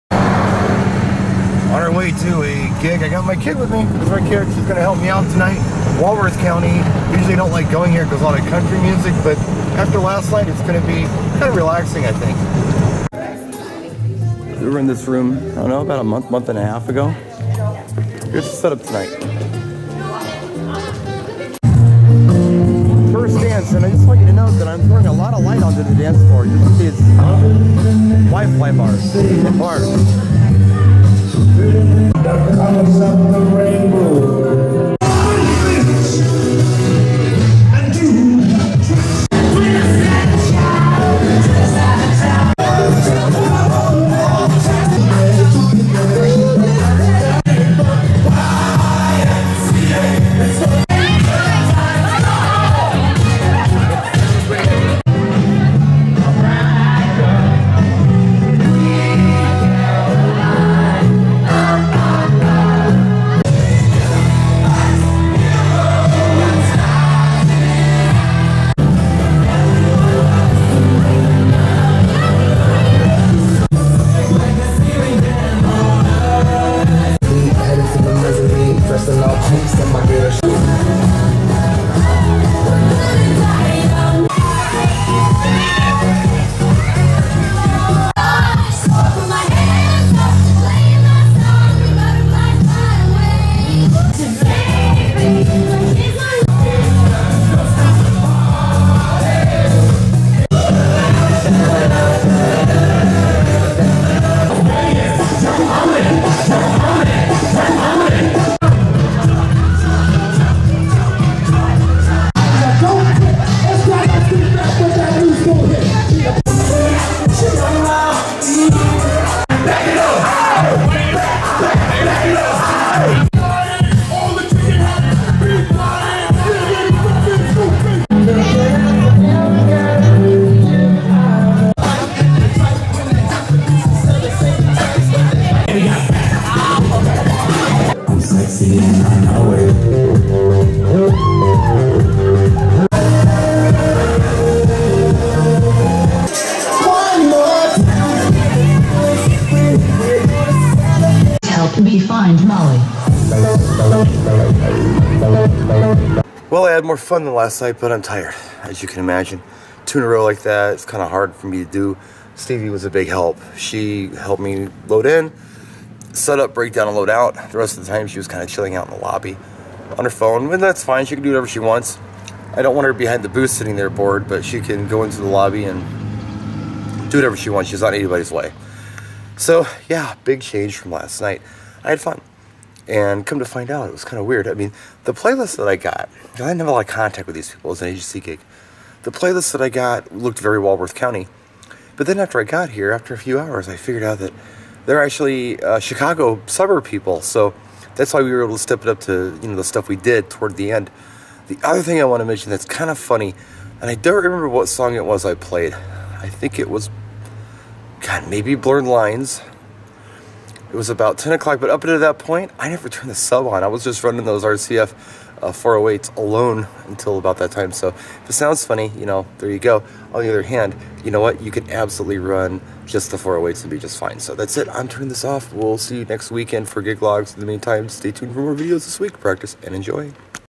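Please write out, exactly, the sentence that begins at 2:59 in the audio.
So, yeah, big change from last night.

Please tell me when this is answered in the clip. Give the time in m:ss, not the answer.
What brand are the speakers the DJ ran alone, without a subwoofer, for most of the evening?
3:34.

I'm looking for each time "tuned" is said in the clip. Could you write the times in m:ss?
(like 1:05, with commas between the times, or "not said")
3:48.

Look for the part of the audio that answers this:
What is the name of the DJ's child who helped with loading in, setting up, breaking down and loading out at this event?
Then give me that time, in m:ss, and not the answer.
2:42.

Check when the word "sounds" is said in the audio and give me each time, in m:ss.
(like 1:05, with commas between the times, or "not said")
3:38.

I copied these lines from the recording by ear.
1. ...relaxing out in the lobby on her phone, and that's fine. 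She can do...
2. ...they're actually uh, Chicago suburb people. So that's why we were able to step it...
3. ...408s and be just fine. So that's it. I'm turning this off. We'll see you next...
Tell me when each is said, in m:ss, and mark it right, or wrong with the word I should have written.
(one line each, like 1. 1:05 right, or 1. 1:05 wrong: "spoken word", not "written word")
1. 2:48 wrong: "chilling", not "relaxing"
2. 3:14 right
3. 3:43 right.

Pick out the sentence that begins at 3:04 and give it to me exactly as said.
I mean, the playlist that I got, I didn't have a lot of contact with these people.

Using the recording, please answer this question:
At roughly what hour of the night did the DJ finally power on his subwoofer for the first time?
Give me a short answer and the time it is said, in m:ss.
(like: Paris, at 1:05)
10 o'clock, at 3:31.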